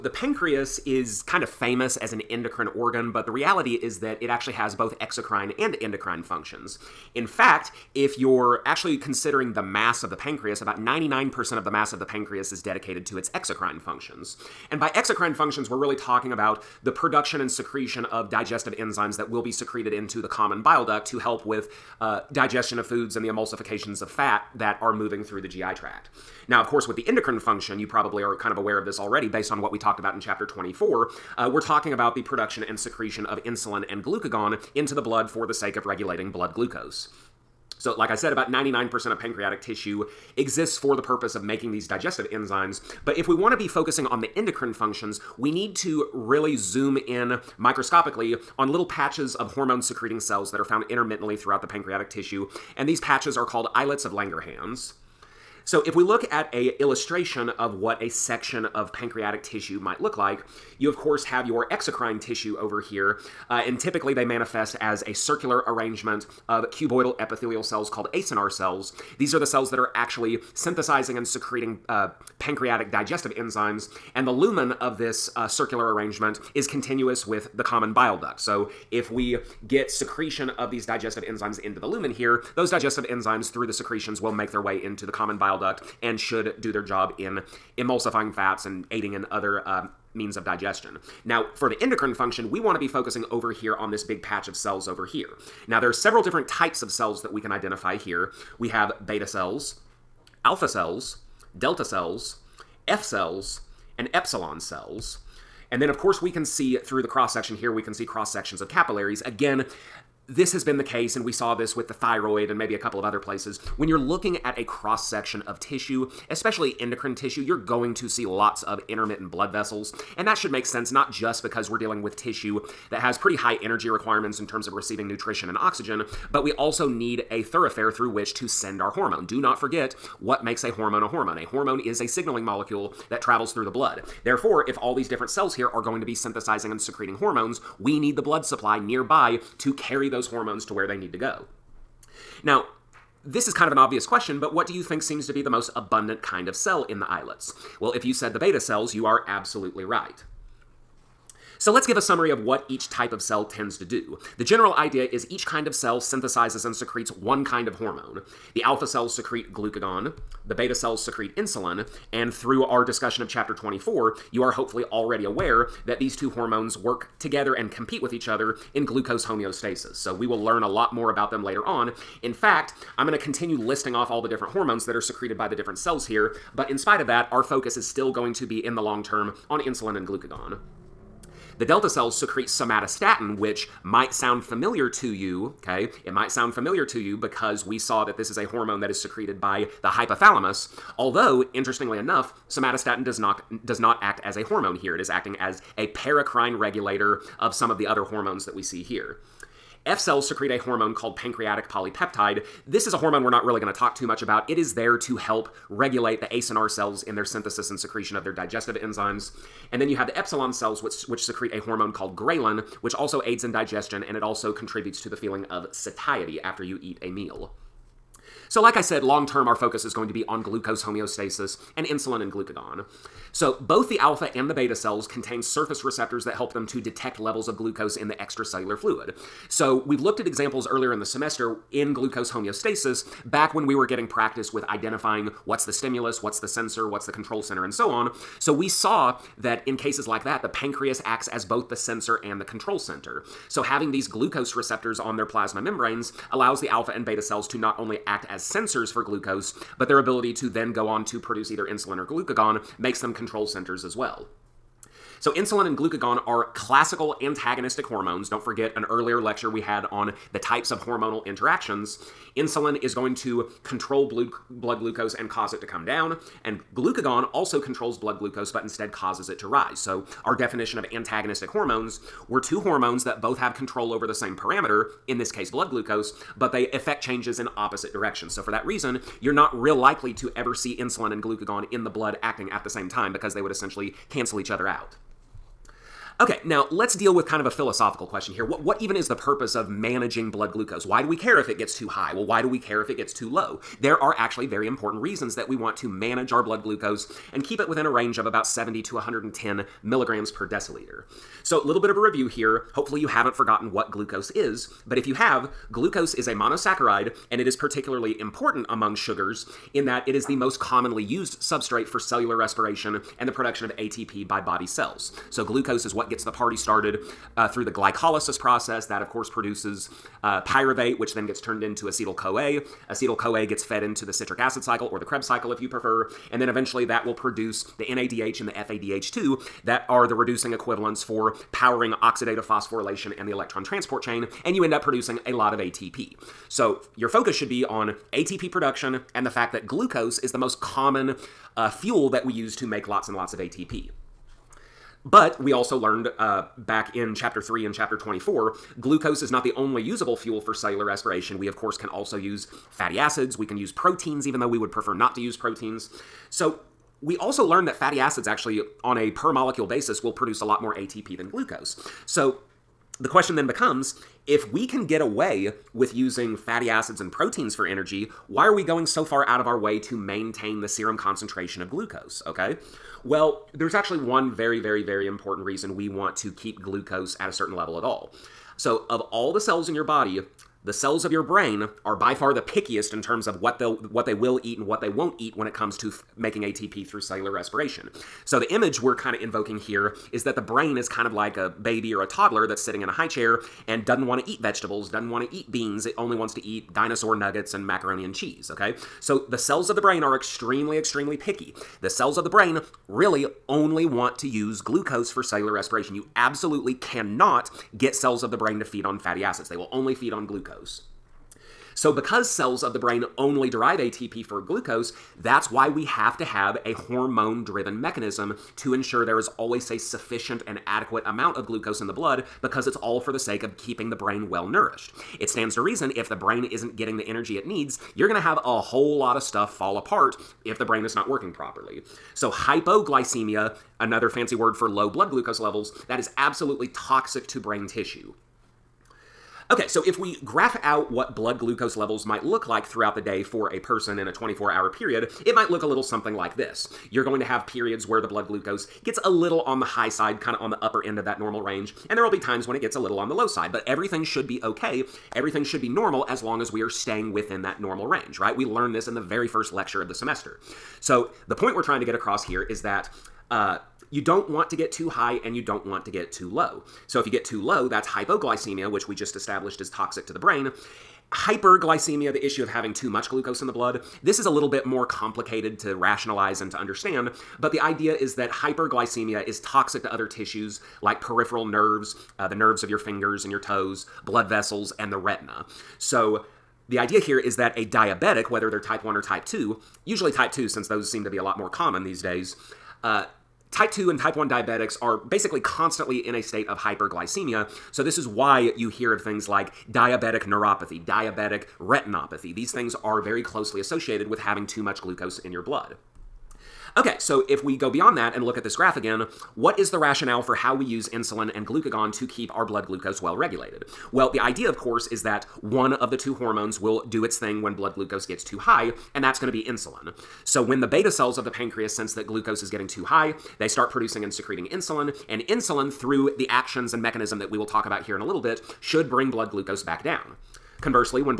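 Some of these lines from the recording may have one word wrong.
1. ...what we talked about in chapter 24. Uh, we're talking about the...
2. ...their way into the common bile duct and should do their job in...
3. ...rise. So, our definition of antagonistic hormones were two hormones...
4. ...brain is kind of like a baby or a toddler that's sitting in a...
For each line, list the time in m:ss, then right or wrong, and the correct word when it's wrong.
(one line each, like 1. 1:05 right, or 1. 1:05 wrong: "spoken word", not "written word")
1. 0:29 right
2. 1:24 right
3. 4:29 right
4. 6:30 right.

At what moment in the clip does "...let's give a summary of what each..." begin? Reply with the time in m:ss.
2:31.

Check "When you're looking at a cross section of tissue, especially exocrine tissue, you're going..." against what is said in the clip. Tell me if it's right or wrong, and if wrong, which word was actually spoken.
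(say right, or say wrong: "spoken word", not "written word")
wrong: "endocrine", not "exocrine".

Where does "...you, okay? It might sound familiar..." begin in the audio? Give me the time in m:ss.
3:05.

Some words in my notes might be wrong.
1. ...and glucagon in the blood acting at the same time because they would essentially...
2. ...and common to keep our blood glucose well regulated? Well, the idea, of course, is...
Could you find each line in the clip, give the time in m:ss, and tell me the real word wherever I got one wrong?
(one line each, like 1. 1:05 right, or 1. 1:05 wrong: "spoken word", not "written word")
1. 4:41 right
2. 8:31 wrong: "glucagon", not "common".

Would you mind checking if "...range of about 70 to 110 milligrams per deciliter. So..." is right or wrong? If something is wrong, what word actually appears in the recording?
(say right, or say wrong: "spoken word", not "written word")
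right.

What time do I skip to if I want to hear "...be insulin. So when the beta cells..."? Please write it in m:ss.
8:39.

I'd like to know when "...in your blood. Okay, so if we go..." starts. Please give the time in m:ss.
8:25.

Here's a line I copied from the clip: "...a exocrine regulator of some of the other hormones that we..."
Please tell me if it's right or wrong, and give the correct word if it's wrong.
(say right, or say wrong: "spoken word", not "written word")
wrong: "paracrine", not "exocrine".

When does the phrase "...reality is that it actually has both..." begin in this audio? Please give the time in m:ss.
0:03.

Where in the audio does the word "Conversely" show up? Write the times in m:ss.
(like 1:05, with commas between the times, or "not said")
8:50.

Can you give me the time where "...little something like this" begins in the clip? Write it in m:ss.
7:25.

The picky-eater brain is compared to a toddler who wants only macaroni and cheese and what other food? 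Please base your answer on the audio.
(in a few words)
dinosaur nuggets.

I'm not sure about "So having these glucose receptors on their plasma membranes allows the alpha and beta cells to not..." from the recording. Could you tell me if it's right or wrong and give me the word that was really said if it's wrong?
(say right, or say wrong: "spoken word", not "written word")
right.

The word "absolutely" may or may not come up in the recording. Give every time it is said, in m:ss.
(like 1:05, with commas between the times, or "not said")
2:29, 6:46, 7:16.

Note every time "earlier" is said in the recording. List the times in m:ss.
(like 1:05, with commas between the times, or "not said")
3:50, 4:18.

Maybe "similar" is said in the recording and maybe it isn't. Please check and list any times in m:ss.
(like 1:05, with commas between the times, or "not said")
not said.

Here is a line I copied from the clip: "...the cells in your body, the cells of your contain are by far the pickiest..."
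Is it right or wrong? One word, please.
wrong.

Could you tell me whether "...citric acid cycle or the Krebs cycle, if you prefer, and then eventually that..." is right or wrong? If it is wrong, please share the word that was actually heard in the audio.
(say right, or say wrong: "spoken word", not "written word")
right.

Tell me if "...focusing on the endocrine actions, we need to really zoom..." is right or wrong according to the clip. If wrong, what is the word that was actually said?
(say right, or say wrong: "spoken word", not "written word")
wrong: "functions", not "actions".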